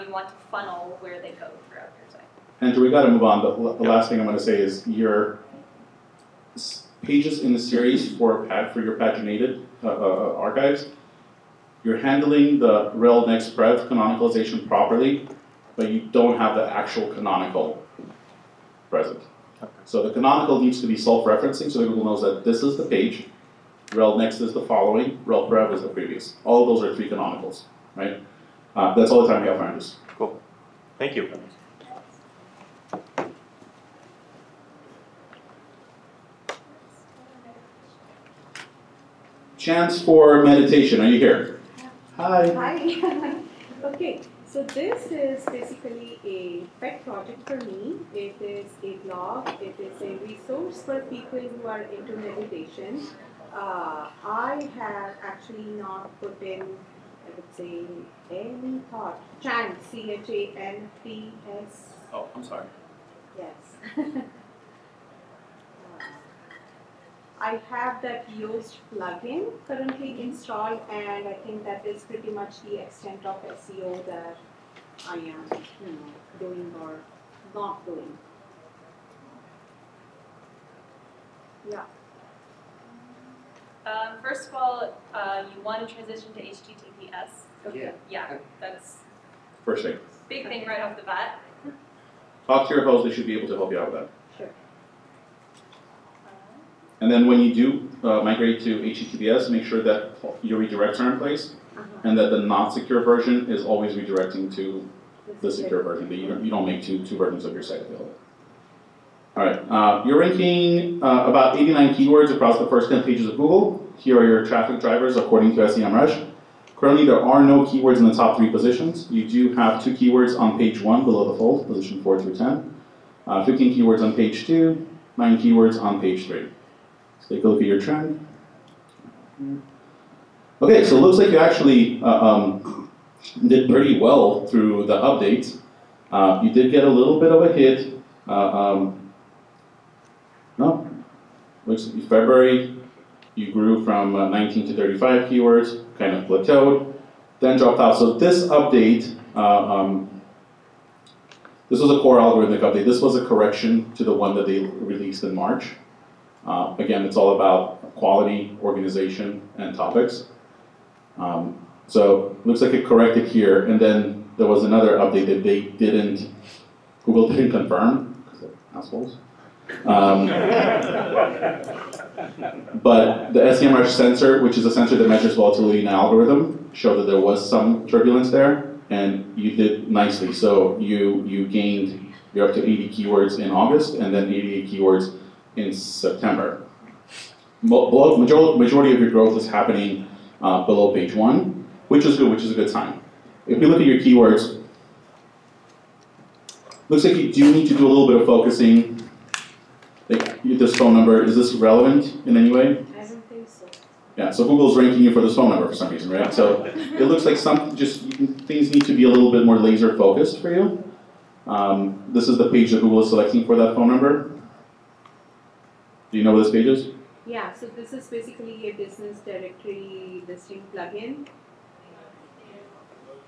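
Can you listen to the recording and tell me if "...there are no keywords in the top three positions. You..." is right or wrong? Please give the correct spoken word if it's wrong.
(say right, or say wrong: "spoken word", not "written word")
right.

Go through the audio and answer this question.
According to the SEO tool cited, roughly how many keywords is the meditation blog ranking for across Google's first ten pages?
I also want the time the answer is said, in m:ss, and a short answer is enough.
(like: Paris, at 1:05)
89, at 1:51.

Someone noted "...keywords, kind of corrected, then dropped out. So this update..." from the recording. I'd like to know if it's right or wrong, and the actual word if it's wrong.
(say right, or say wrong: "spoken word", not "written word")
wrong: "plateaued", not "corrected".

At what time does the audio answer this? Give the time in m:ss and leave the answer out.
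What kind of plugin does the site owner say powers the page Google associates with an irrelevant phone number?
3:38.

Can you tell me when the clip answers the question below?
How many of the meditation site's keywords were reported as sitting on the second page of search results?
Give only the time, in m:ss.
2:03.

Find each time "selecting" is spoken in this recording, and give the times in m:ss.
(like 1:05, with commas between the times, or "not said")
3:33.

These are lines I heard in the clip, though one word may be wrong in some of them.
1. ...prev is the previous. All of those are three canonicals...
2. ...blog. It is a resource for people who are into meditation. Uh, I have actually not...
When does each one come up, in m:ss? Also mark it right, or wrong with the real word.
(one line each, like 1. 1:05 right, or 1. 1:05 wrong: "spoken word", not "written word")
1. 0:25 right
2. 0:49 right.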